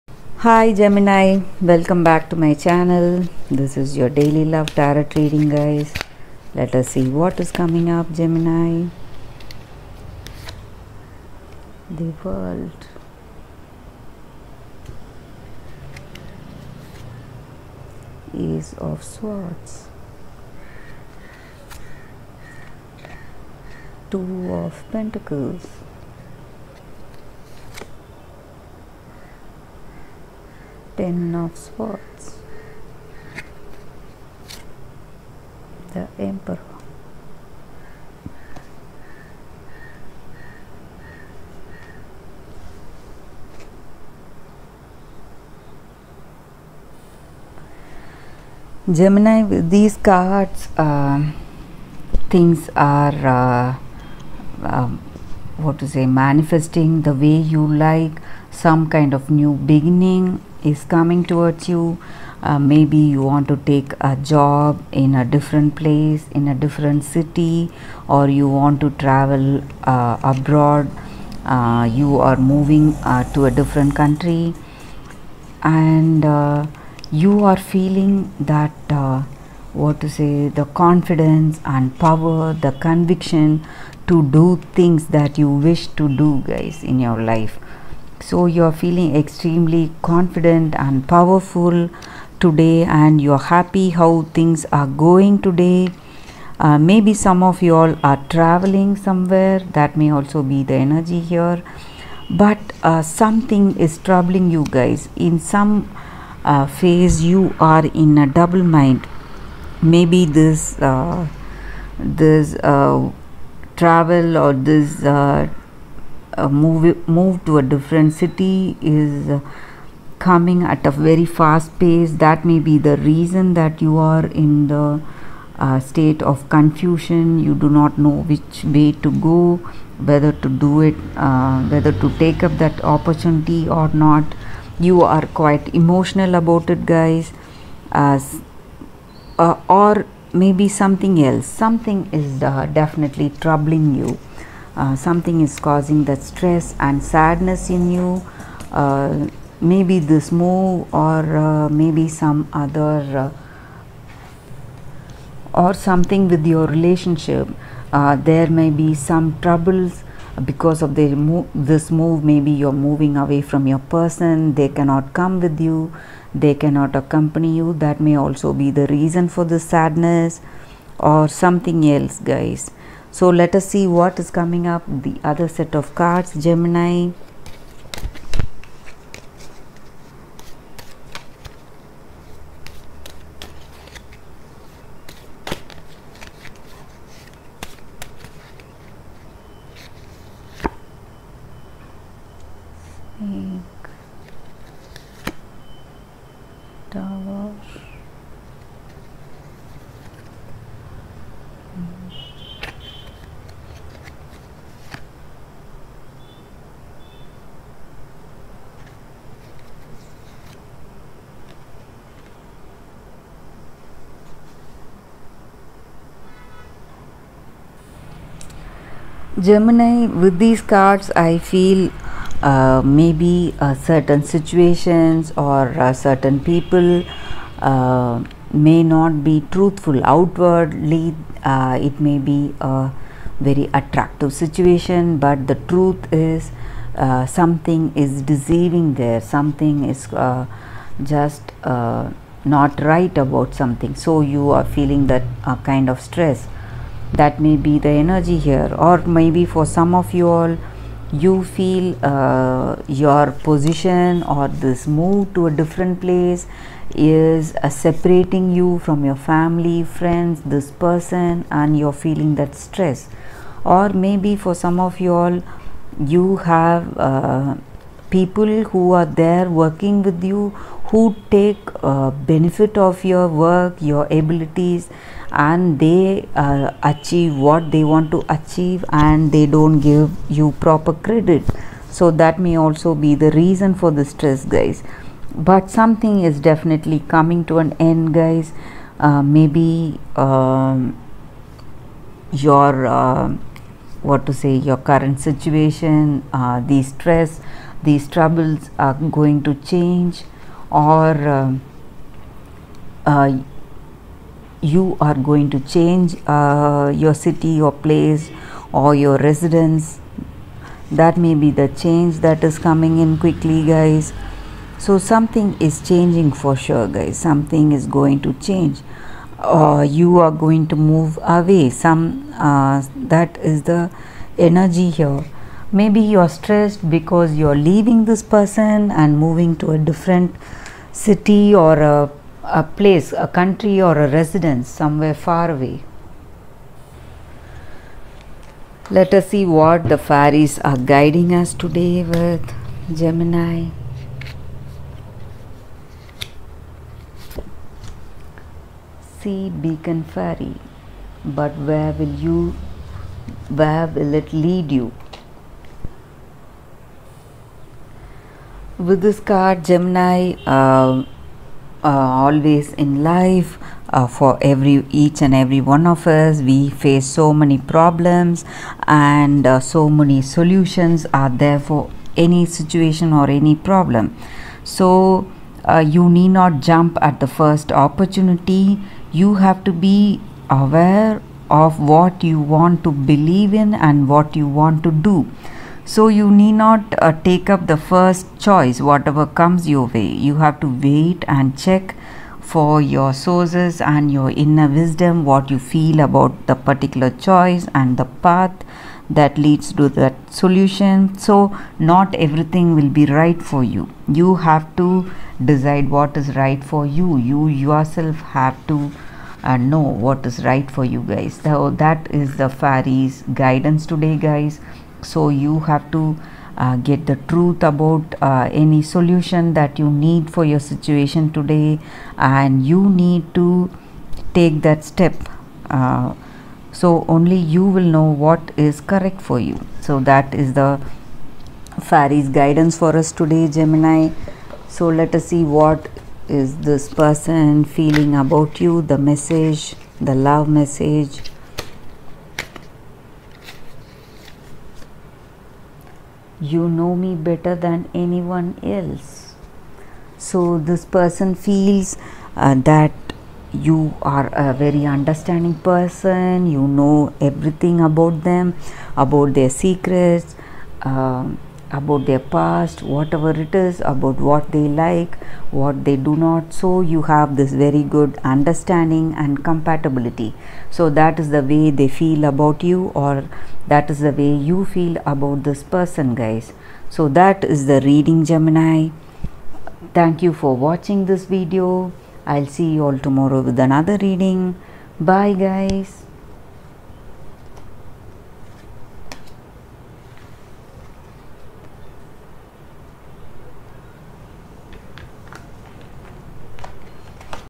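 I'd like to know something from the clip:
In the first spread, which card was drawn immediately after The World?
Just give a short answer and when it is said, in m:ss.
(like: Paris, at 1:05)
Six of Swords, at 0:18.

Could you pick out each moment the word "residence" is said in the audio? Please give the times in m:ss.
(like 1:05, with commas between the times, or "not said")
5:09, 5:34.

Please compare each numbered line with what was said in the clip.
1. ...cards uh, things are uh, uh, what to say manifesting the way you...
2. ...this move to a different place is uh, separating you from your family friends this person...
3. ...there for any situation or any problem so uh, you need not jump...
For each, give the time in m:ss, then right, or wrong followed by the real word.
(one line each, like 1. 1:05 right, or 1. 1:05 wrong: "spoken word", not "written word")
1. 0:49 right
2. 4:14 right
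3. 6:11 right.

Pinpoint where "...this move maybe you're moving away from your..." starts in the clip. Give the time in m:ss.
2:40.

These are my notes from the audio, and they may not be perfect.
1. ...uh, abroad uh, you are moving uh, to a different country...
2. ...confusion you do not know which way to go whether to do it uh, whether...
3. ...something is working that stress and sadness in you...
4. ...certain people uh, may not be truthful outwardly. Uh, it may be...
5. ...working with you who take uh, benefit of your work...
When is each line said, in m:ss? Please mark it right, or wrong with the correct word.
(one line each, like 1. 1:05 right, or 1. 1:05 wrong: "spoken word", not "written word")
1. 1:09 right
2. 2:06 right
3. 2:24 wrong: "causing", not "working"
4. 3:45 right
5. 4:29 right.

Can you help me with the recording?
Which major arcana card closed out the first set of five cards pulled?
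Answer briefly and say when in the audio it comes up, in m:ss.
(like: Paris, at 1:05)
The Emperor, at 0:35.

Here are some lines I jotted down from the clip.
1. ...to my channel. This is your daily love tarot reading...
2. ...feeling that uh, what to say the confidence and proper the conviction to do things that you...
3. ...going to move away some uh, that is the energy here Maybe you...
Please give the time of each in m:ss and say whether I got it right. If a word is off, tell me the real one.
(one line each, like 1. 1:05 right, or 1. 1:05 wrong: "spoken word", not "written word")
1. 0:02 right
2. 1:17 wrong: "power", not "proper"
3. 5:20 right.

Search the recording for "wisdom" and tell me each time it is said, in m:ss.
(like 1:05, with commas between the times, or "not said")
6:34.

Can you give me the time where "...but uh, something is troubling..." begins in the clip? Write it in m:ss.
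1:42.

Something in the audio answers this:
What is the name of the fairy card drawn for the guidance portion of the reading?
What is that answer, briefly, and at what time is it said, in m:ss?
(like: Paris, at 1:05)
Beacon fairy, at 5:49.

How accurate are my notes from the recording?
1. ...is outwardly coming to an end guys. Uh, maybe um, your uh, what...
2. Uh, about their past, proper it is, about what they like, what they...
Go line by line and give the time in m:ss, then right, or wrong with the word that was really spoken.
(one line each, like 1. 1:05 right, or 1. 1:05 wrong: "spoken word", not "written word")
1. 4:46 wrong: "definitely", not "outwardly"
2. 7:40 wrong: "whatever", not "proper".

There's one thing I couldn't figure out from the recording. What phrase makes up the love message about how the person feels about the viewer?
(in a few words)
You know me better than anyone else.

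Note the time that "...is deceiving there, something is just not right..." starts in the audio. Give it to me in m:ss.
3:57.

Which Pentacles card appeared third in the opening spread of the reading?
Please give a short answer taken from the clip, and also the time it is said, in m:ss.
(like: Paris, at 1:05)
Two of Pentacles, at 0:24.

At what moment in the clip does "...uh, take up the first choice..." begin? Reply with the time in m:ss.
6:27.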